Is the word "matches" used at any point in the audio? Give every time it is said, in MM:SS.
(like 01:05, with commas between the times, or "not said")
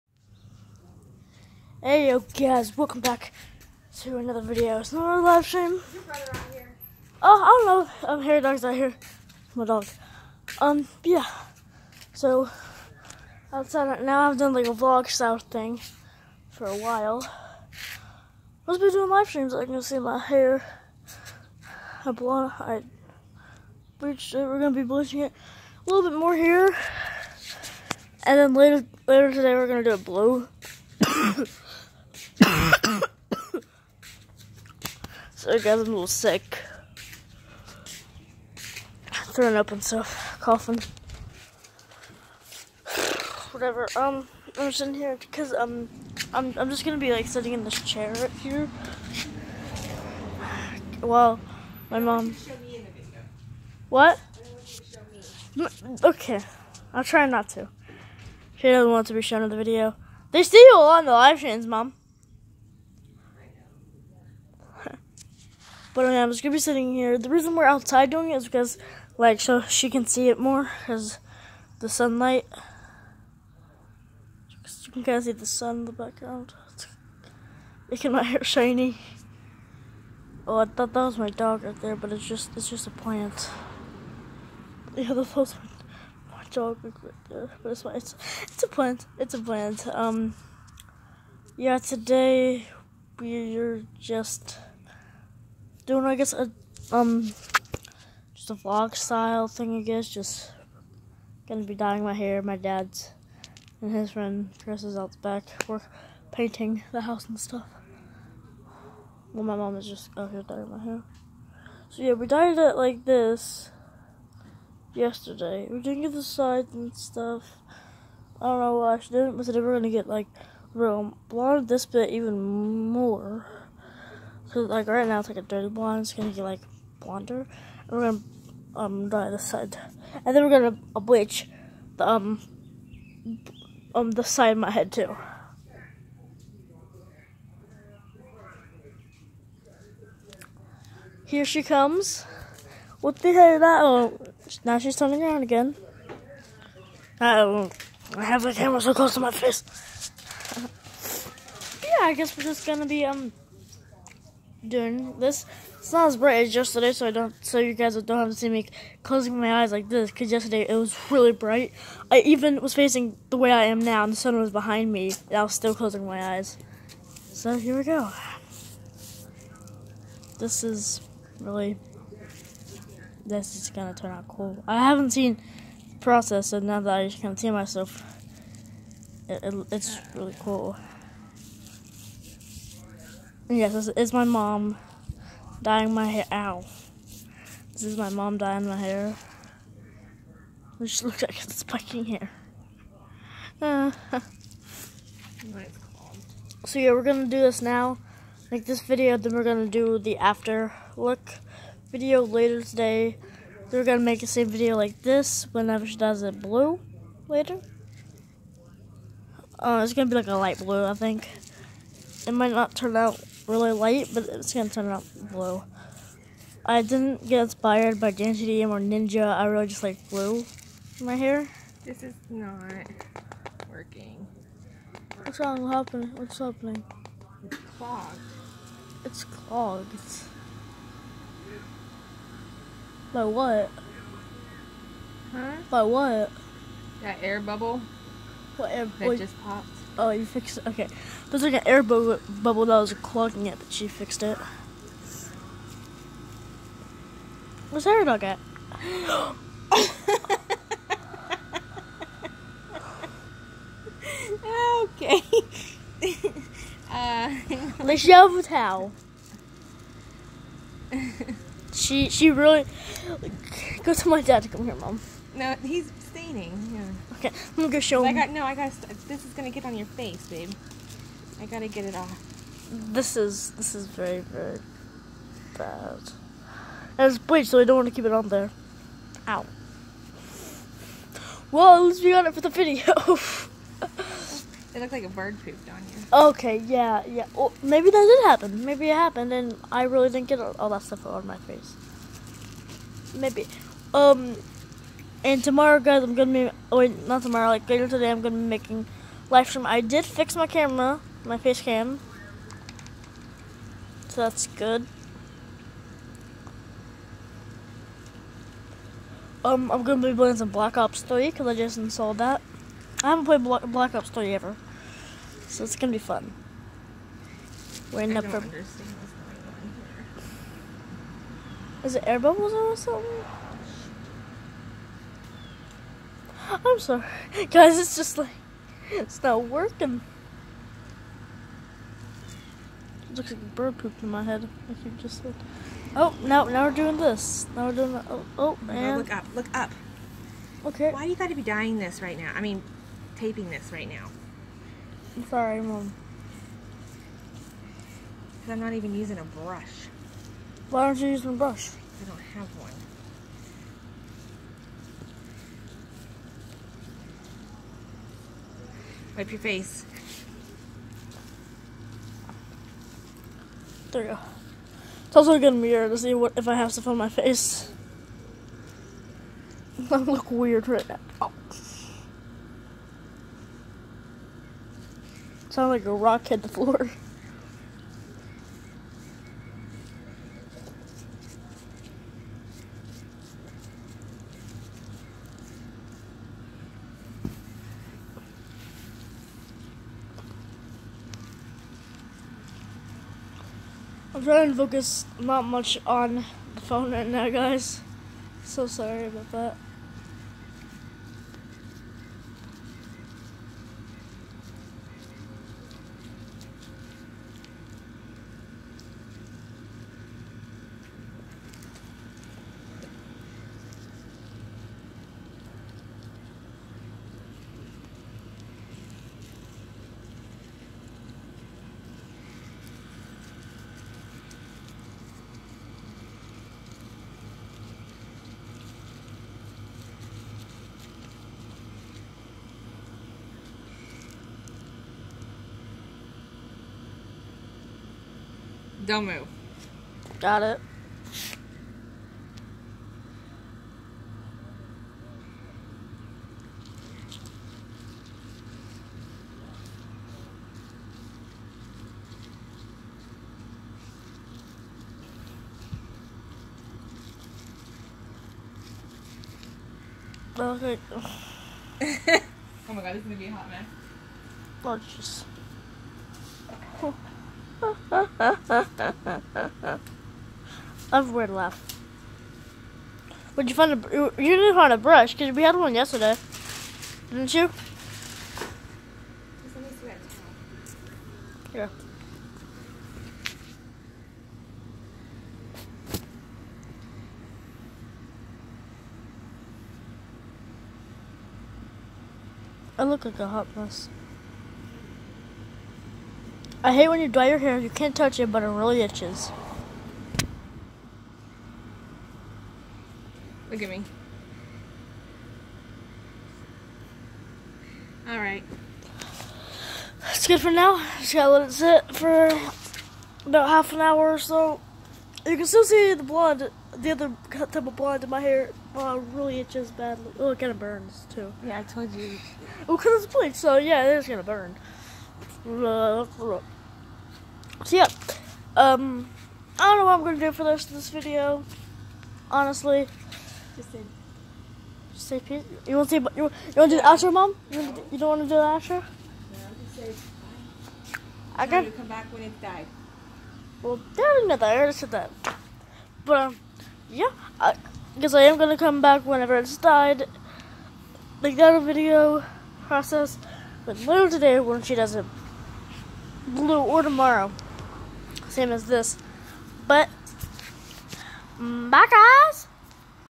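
not said.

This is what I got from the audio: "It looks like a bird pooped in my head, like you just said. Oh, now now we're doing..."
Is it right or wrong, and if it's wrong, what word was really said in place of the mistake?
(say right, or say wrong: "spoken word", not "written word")
right.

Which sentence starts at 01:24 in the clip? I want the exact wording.
Yeah, that was my, my dog right there, but it's my, it's it's a plant.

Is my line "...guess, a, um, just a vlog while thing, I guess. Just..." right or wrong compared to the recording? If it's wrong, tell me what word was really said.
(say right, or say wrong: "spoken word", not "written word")
wrong: "style", not "while".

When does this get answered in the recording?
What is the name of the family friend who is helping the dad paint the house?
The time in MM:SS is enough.
01:44.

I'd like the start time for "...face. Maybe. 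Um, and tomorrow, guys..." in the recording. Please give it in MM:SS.
04:51.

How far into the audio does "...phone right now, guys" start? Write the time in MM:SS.
06:36.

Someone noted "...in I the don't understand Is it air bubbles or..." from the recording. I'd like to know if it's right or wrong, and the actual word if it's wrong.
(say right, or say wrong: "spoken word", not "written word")
right.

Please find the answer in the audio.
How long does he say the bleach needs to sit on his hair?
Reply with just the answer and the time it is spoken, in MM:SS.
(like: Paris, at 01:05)
Half an hour, at 08:33.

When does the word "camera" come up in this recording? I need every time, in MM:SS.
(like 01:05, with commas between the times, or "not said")
02:28, 05:00.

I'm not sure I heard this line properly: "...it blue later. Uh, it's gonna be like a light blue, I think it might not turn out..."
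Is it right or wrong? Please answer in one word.
right.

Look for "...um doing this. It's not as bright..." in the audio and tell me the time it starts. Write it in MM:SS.
02:33.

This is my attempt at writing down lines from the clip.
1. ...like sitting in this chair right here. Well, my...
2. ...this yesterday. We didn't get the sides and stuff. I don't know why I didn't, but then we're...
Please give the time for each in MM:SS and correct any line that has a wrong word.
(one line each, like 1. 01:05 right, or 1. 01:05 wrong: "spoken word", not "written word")
1. 00:47 right
2. 01:53 right.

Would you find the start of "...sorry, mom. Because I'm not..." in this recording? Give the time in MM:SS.
05:45.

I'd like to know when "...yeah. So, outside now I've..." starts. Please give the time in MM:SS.
00:11.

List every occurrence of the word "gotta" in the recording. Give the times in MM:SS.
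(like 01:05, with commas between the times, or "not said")
04:31, 08:31.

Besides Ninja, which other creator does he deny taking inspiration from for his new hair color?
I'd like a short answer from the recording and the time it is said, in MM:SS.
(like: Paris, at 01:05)
DanTDM, at 03:38.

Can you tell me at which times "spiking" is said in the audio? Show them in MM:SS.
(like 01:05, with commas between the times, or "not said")
03:11.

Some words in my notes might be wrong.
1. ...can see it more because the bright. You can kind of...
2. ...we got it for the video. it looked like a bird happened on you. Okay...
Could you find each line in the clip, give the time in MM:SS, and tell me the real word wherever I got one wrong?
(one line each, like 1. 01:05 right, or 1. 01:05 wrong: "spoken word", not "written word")
1. 01:09 wrong: "sunlight", not "bright"
2. 04:42 wrong: "pooped", not "happened".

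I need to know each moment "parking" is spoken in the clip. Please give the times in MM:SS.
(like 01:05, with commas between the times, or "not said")
not said.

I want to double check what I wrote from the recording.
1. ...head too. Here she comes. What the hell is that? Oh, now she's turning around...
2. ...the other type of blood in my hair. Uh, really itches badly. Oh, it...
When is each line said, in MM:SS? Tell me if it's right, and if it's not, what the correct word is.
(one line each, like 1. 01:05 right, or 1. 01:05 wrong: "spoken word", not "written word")
1. 02:14 right
2. 08:36 right.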